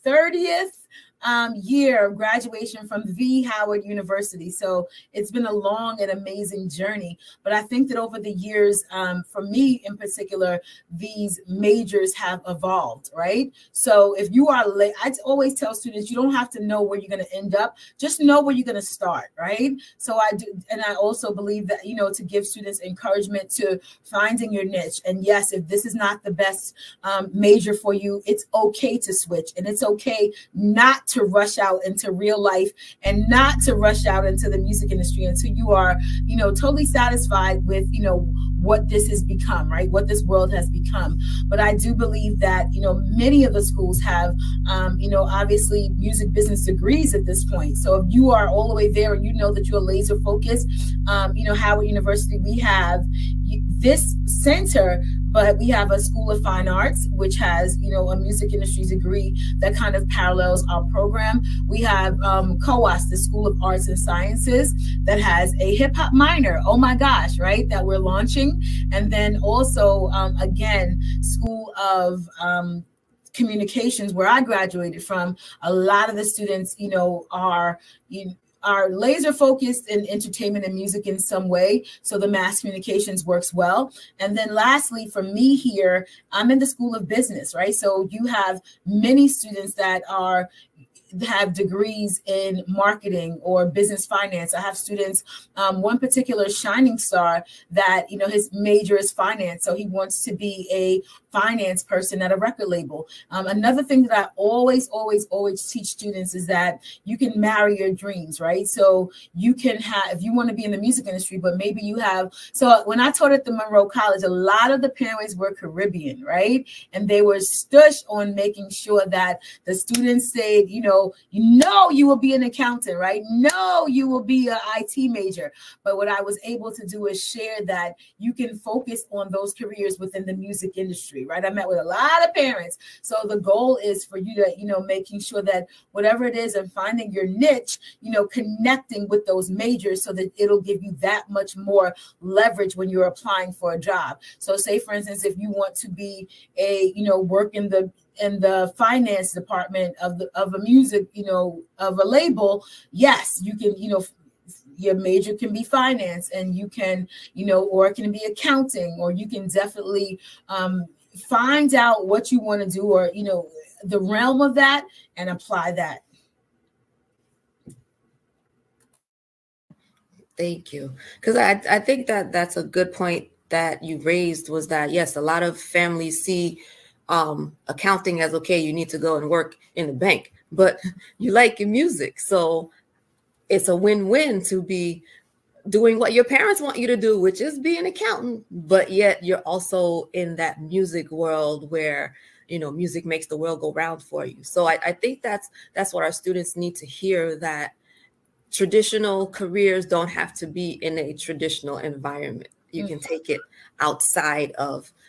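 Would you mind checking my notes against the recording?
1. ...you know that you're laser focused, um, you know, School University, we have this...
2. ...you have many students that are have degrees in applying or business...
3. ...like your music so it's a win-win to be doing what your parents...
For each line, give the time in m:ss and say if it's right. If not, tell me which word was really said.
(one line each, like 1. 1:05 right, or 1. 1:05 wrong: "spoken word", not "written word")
1. 0:49 wrong: "Howard", not "School"
2. 1:28 wrong: "marketing", not "applying"
3. 3:01 right.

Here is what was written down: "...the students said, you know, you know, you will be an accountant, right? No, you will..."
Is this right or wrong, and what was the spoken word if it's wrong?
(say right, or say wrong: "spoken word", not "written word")
right.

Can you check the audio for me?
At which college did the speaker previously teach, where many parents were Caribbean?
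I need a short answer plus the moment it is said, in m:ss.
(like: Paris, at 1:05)
Monroe College, at 1:53.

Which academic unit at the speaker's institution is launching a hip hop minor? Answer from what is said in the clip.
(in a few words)
School of Arts and Sciences.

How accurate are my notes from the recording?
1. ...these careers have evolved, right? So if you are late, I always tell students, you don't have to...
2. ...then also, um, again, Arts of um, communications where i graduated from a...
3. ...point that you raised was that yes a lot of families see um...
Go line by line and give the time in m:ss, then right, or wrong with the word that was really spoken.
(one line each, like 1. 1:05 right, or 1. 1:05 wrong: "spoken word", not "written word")
1. 0:10 wrong: "majors", not "careers"
2. 1:09 wrong: "School", not "Arts"
3. 2:52 right.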